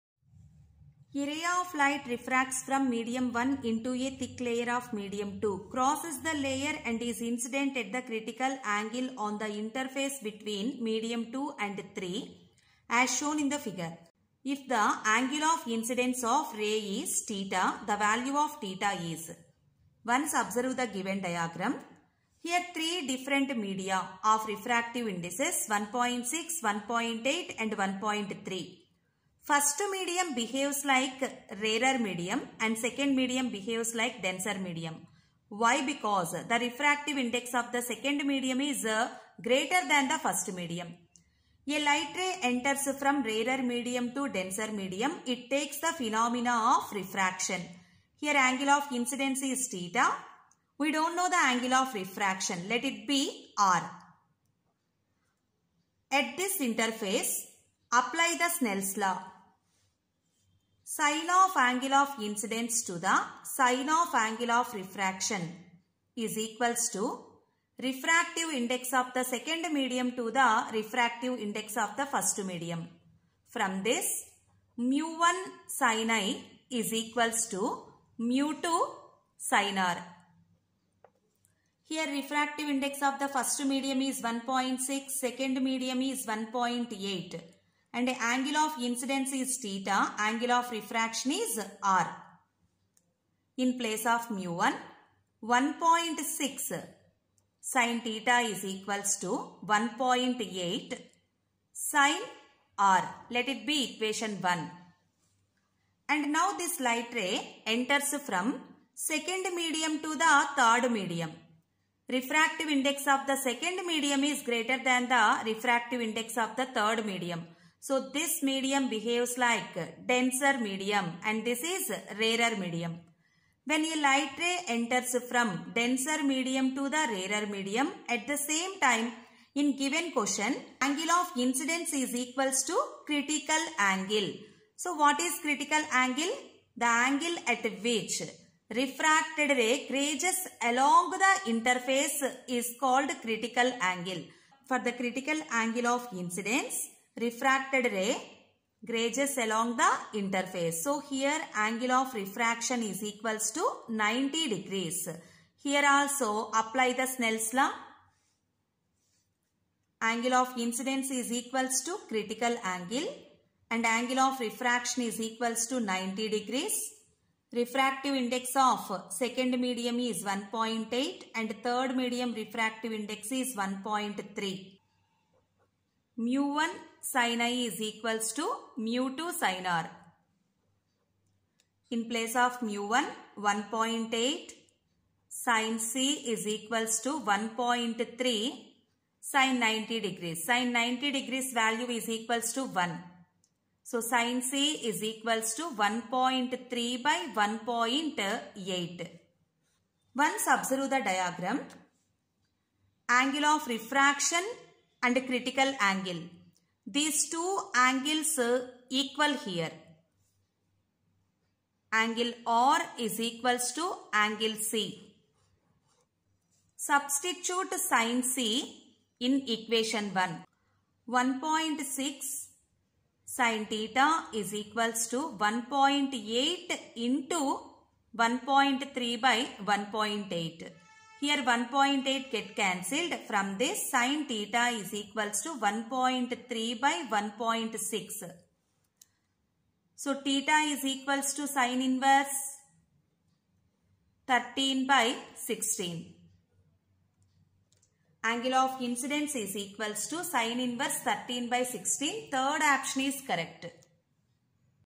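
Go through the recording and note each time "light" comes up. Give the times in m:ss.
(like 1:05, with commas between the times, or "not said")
0:01, 0:41, 1:46, 2:04.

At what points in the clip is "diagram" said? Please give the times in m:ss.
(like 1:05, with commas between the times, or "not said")
0:21, 3:21.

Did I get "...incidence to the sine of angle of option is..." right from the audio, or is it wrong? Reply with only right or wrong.
wrong.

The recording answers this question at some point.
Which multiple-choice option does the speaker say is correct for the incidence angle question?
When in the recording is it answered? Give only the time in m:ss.
4:12.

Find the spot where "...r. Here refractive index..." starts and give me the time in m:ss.
1:19.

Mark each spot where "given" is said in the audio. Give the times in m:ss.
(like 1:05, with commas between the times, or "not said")
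0:20, 2:09.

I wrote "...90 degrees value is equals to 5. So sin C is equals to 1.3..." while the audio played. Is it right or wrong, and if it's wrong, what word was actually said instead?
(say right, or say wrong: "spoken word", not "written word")
wrong: "1", not "5".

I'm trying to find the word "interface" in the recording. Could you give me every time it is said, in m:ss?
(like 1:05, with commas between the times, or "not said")
0:09, 0:56, 2:21, 2:30.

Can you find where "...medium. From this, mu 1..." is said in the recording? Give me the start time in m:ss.
1:12.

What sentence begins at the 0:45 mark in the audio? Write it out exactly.
It takes the phenomena of refraction.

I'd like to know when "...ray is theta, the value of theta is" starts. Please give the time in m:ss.
0:16.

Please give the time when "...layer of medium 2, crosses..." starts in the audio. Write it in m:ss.
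0:04.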